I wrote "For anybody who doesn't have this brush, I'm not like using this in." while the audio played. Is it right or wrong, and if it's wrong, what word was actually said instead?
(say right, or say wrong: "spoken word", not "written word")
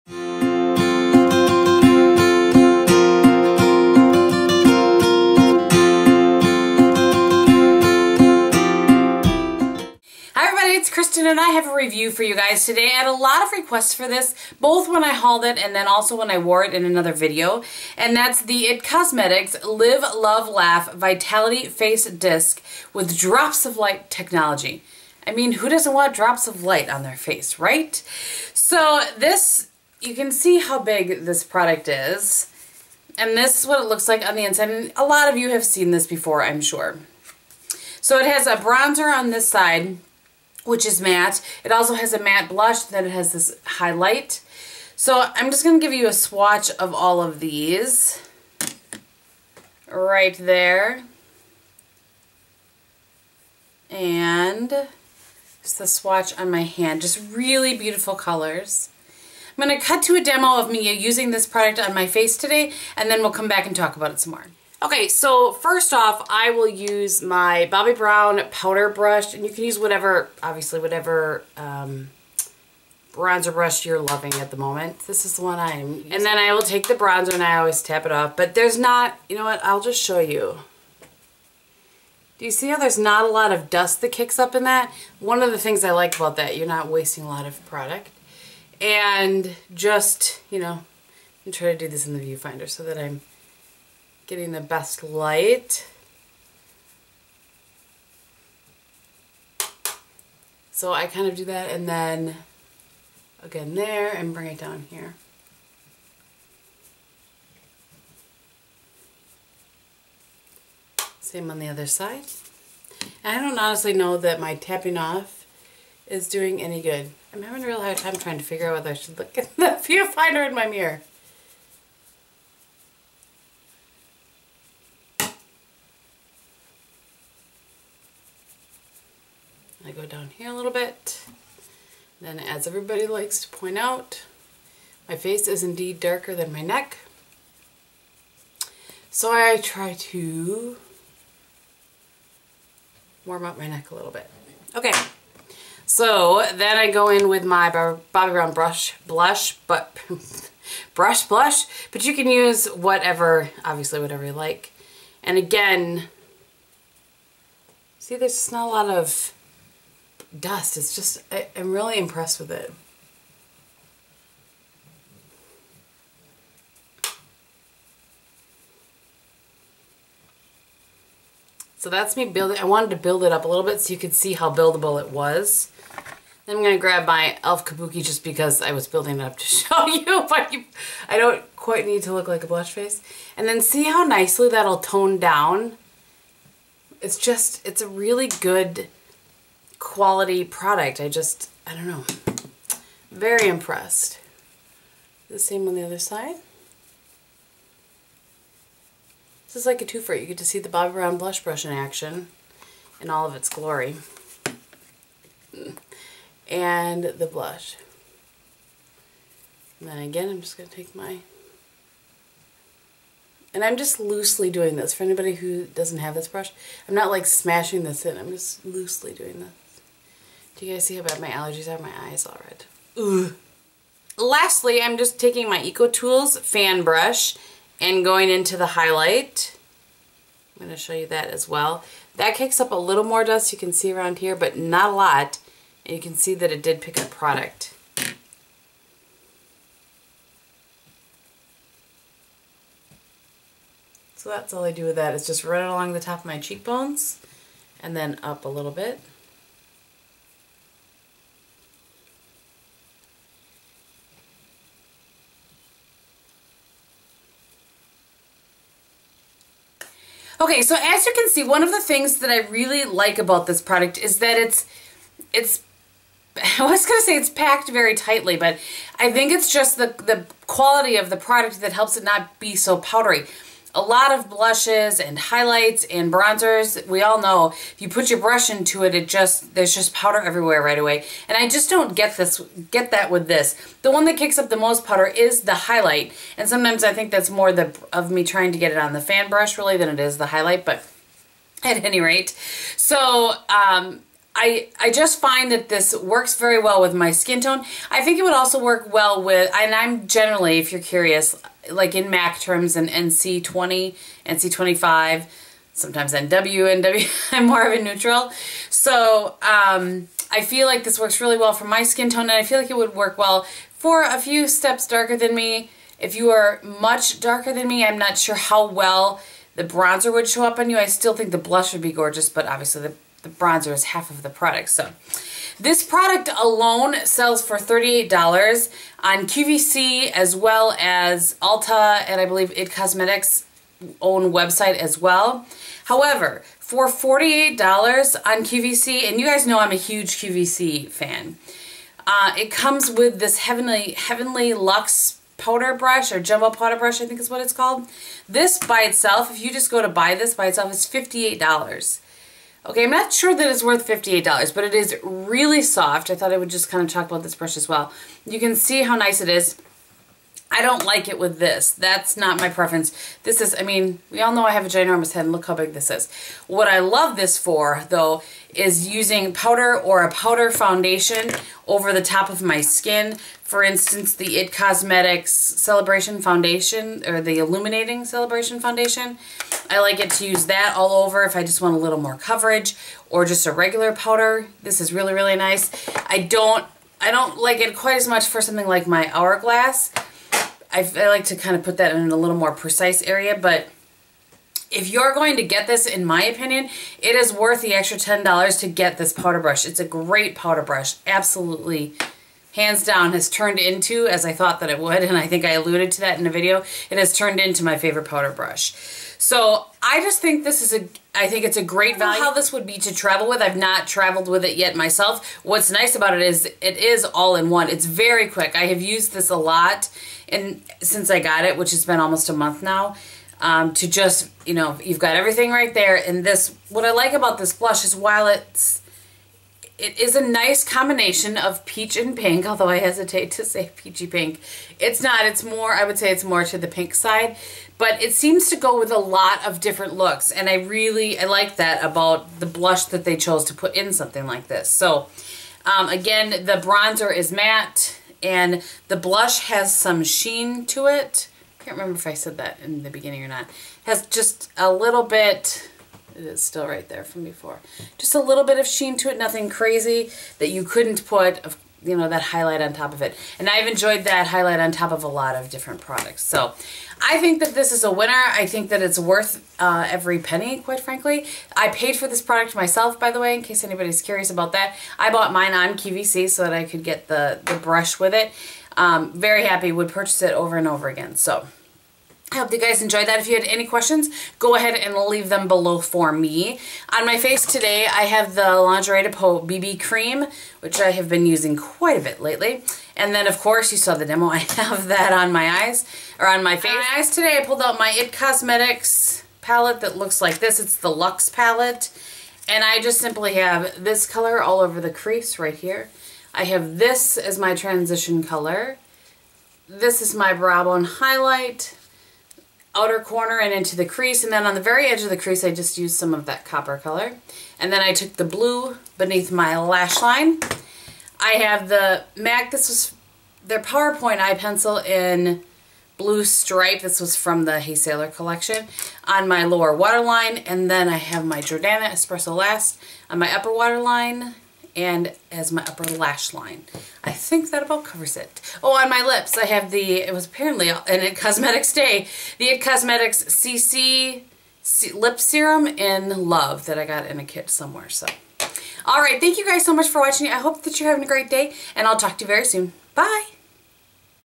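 wrong: "smashing", not "using".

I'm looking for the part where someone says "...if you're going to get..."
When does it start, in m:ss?
6:34.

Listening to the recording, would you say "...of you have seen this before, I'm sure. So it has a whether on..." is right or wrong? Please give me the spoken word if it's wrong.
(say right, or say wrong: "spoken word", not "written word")
wrong: "bronzer", not "whether".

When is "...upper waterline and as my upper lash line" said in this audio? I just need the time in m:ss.
8:53.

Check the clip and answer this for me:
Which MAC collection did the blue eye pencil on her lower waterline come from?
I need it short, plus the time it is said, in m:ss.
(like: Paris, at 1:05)
Hey Sailor, at 8:47.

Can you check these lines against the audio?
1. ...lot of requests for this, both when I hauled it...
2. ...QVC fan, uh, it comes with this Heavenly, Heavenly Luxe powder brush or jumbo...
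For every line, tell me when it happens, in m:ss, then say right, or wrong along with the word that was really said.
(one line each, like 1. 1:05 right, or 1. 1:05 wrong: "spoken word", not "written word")
1. 0:13 right
2. 5:40 right.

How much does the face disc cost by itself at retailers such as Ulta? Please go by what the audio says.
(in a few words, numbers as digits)
$38.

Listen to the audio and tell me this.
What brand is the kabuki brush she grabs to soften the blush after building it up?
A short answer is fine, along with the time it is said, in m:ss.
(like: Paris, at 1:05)
e.l.f., at 2:57.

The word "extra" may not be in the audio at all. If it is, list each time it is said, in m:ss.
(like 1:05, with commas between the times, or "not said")
6:37.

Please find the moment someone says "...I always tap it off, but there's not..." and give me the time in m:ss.
1:17.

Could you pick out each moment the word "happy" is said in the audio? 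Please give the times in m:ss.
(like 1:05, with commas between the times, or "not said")
7:59.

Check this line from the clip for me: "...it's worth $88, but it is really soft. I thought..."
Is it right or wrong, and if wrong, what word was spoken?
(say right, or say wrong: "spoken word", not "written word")
wrong: "58", not "88".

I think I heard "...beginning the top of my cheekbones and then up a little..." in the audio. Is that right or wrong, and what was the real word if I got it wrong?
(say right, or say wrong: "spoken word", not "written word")
wrong: "along", not "beginning".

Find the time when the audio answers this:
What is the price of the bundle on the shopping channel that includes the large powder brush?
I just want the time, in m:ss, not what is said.
5:36.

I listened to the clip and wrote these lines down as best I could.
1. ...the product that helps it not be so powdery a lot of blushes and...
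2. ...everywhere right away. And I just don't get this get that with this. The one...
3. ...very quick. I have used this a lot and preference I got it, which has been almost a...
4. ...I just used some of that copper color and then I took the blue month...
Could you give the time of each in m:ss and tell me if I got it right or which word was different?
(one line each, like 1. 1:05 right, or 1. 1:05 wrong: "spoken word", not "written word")
1. 4:31 right
2. 4:40 right
3. 6:57 wrong: "since", not "preference"
4. 8:35 wrong: "beneath", not "month".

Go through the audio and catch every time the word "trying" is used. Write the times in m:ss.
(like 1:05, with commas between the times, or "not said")
1:31, 1:58, 4:48.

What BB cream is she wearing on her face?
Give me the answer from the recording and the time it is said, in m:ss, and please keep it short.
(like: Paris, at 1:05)
Lingerie de Peau, at 8:08.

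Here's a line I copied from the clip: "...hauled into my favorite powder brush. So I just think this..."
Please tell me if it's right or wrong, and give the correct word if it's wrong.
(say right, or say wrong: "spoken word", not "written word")
wrong: "turned", not "hauled".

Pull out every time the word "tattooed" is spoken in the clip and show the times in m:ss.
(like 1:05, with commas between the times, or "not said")
not said.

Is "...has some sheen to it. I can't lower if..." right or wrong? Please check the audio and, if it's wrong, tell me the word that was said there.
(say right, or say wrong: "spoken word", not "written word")
wrong: "remember", not "lower".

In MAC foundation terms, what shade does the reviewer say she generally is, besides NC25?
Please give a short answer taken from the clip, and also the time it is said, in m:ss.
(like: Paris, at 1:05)
NC20, at 5:02.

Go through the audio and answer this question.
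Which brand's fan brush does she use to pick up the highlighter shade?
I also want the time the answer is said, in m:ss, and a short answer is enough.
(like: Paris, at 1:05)
Eco Tools, at 3:45.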